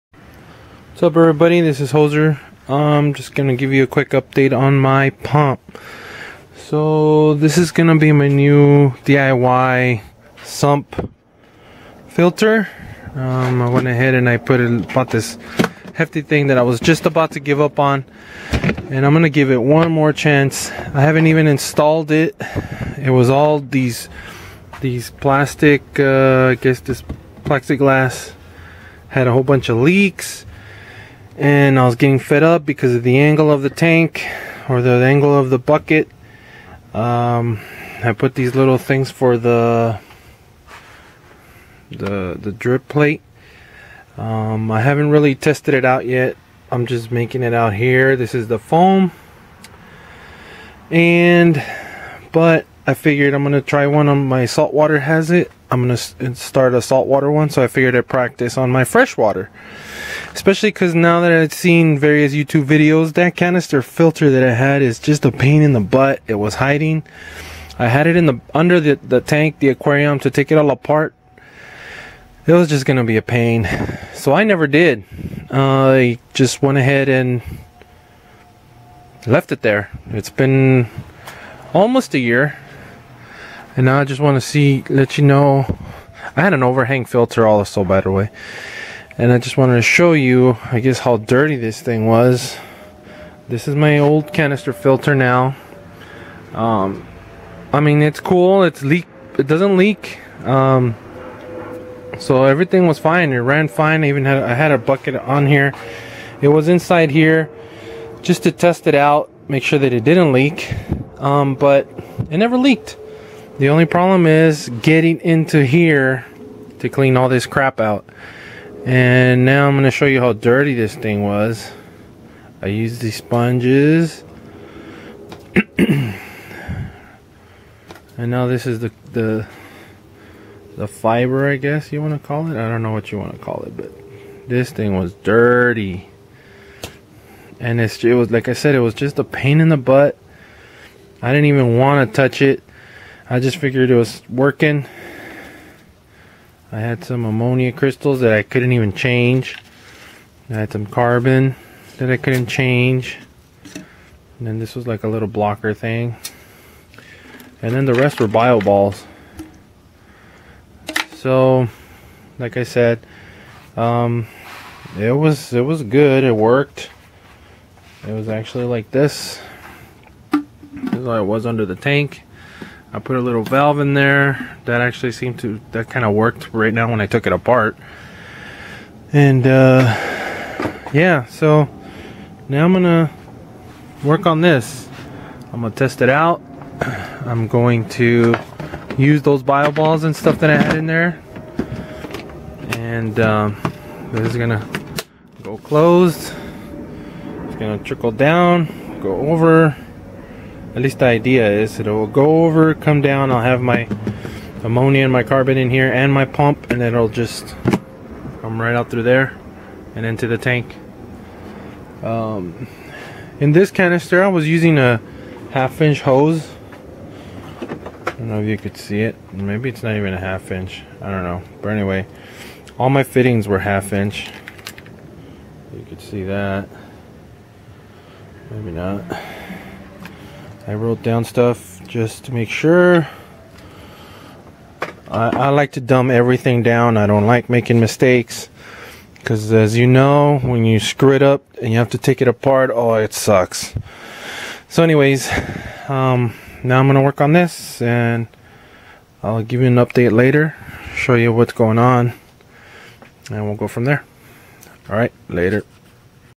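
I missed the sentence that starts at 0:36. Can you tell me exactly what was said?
Um, I put these little things for the the the drip plate.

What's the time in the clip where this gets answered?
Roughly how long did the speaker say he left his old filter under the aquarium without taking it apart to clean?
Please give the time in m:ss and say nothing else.
1:21.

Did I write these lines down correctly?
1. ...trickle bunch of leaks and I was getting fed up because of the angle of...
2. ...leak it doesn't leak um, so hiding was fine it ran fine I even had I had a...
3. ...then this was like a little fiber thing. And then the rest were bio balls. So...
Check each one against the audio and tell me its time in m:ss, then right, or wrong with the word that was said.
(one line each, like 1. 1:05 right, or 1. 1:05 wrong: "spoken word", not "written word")
1. 0:29 wrong: "whole", not "trickle"
2. 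1:38 wrong: "everything", not "hiding"
3. 2:34 wrong: "blocker", not "fiber".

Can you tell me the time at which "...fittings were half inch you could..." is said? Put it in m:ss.
3:43.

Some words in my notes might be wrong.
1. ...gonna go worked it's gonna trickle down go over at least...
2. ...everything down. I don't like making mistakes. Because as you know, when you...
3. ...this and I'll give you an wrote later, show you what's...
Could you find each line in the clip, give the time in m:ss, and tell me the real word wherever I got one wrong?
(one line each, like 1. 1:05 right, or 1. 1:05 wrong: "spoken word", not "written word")
1. 3:14 wrong: "closed", not "worked"
2. 3:56 right
3. 4:07 wrong: "update", not "wrote".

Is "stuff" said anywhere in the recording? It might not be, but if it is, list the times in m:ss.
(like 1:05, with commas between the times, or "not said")
3:10, 3:51.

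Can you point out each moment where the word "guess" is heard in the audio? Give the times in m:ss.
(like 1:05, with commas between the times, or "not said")
0:26, 1:30, 2:11.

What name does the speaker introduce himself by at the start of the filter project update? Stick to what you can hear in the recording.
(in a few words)
Jozer.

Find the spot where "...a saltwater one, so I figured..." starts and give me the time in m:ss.
0:56.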